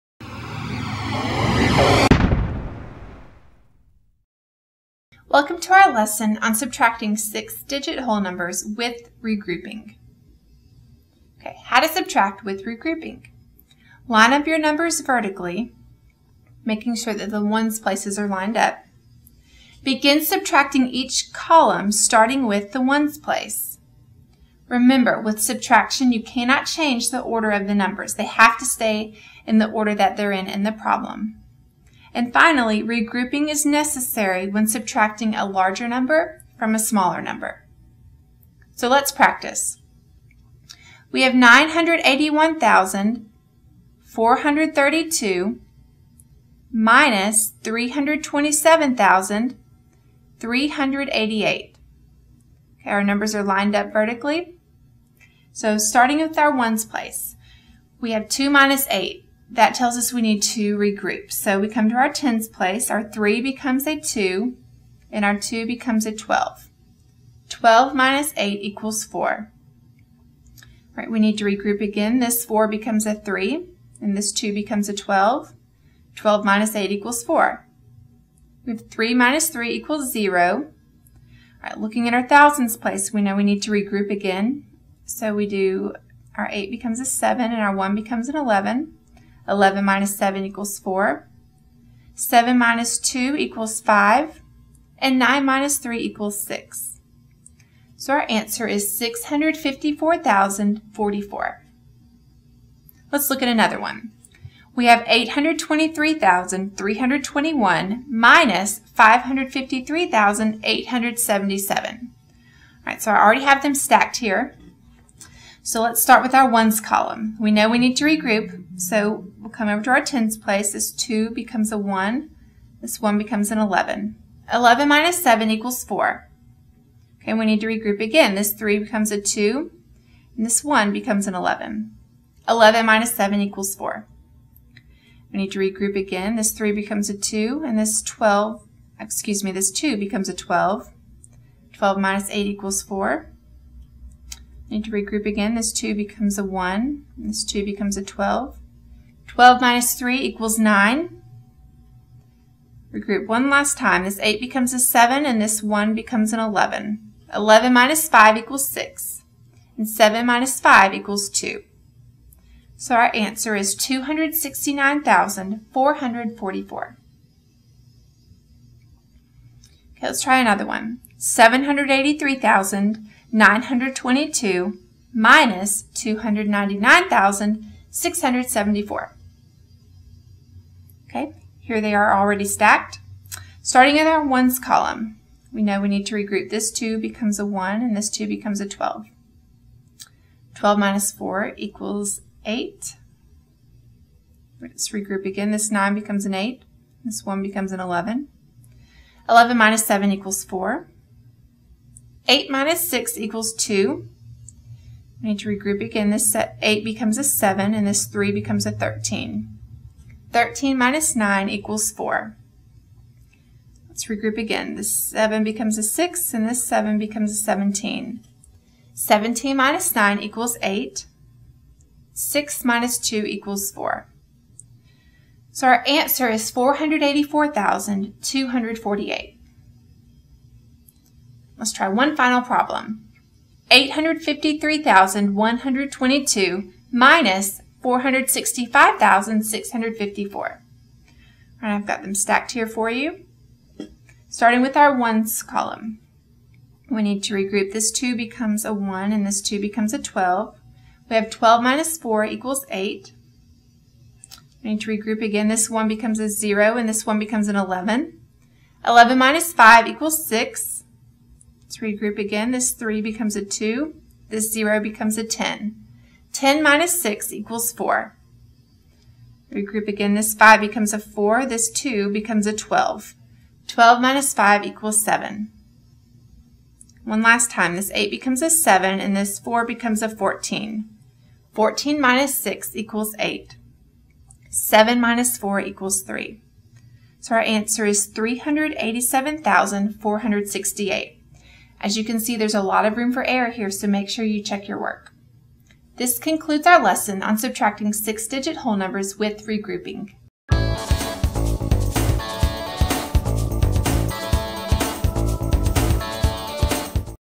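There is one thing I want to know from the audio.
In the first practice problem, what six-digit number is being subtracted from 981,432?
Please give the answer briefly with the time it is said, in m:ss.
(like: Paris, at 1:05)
327,388, at 0:47.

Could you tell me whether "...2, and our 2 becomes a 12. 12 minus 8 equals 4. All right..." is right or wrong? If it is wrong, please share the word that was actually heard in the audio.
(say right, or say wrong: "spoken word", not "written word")
right.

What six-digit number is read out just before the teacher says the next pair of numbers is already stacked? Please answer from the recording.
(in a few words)
465,654.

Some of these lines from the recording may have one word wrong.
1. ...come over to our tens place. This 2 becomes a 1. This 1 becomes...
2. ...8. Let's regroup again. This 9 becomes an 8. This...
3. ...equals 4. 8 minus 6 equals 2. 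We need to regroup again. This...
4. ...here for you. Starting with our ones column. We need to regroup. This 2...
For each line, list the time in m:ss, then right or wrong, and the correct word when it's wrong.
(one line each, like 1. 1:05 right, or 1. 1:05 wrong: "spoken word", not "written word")
1. 1:59 right
2. 3:12 right
3. 3:20 right
4. 4:02 right.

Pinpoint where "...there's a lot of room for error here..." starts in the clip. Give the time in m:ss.
4:52.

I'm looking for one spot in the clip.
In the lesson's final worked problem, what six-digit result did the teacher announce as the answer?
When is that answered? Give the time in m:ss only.
4:48.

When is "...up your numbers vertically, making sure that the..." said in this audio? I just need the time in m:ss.
0:14.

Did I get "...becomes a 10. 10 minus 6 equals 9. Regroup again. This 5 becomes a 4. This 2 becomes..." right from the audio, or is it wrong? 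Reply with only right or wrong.
wrong.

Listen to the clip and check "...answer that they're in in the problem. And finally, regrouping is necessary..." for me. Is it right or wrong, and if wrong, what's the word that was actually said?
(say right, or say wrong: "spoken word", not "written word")
wrong: "order", not "answer".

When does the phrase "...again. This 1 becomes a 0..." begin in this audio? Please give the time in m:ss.
4:15.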